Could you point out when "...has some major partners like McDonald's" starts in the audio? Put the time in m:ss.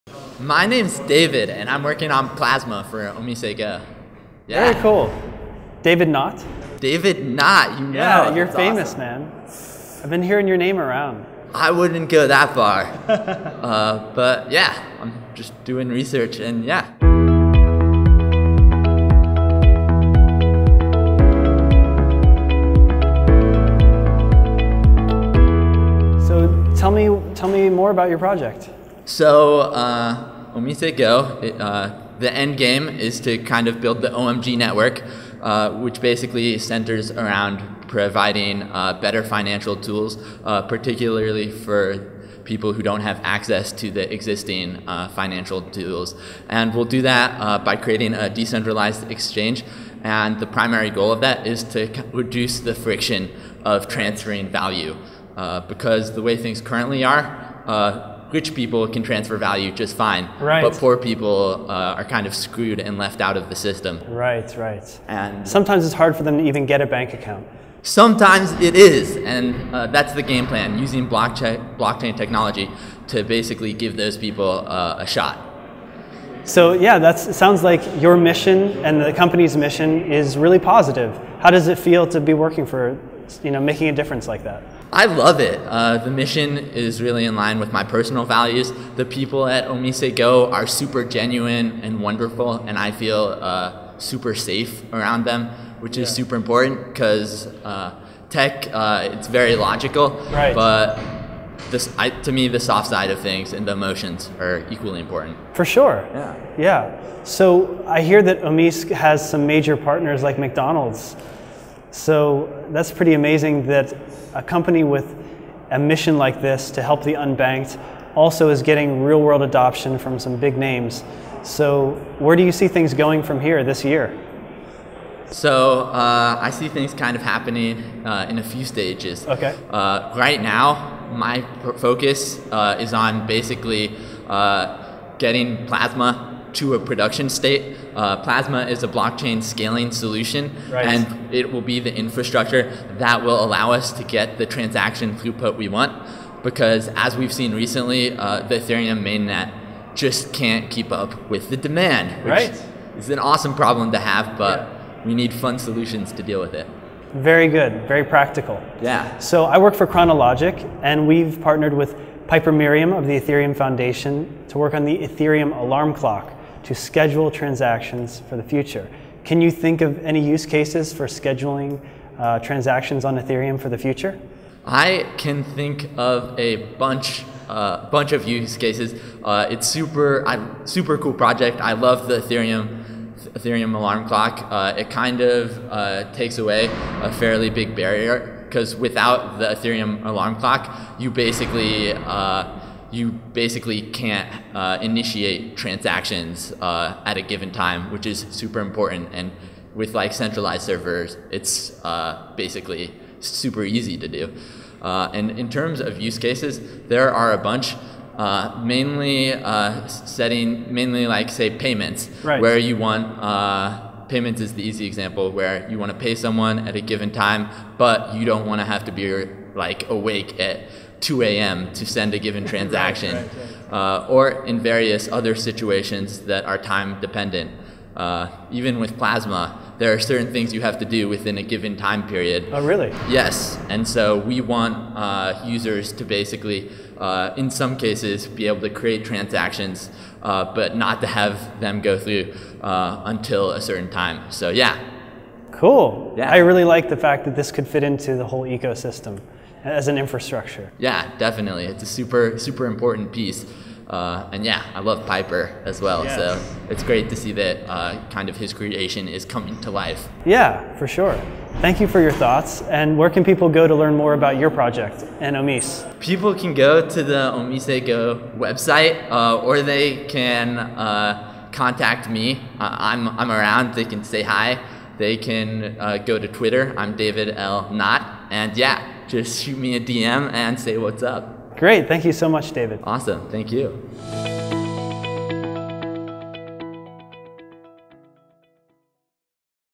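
1:48.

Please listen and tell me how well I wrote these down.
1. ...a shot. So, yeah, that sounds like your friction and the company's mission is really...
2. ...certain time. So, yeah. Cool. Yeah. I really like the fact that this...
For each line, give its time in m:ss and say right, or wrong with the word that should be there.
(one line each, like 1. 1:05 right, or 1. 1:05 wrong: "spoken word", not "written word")
1. 1:14 wrong: "mission", not "friction"
2. 4:03 right.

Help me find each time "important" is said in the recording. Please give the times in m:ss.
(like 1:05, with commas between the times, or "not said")
1:36, 1:44, 3:18, 4:12.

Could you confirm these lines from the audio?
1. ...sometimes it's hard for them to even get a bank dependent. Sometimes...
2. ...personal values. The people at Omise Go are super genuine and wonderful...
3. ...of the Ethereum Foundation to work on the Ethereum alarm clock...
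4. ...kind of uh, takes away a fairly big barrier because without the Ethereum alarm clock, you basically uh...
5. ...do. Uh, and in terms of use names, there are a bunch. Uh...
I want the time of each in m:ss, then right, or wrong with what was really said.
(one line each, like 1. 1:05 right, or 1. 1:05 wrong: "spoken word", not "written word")
1. 1:05 wrong: "account", not "dependent"
2. 1:27 right
3. 2:42 right
4. 3:04 right
5. 3:24 wrong: "cases", not "names".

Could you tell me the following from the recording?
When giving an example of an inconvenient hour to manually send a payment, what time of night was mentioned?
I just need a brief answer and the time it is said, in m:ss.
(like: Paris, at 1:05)
2 a.m., at 3:41.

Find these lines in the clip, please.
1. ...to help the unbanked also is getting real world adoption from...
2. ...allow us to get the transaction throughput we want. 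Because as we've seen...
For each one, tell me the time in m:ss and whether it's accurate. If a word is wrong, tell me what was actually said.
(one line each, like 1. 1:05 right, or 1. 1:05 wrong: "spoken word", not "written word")
1. 1:56 right
2. 2:23 right.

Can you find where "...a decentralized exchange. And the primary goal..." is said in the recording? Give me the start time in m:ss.
0:48.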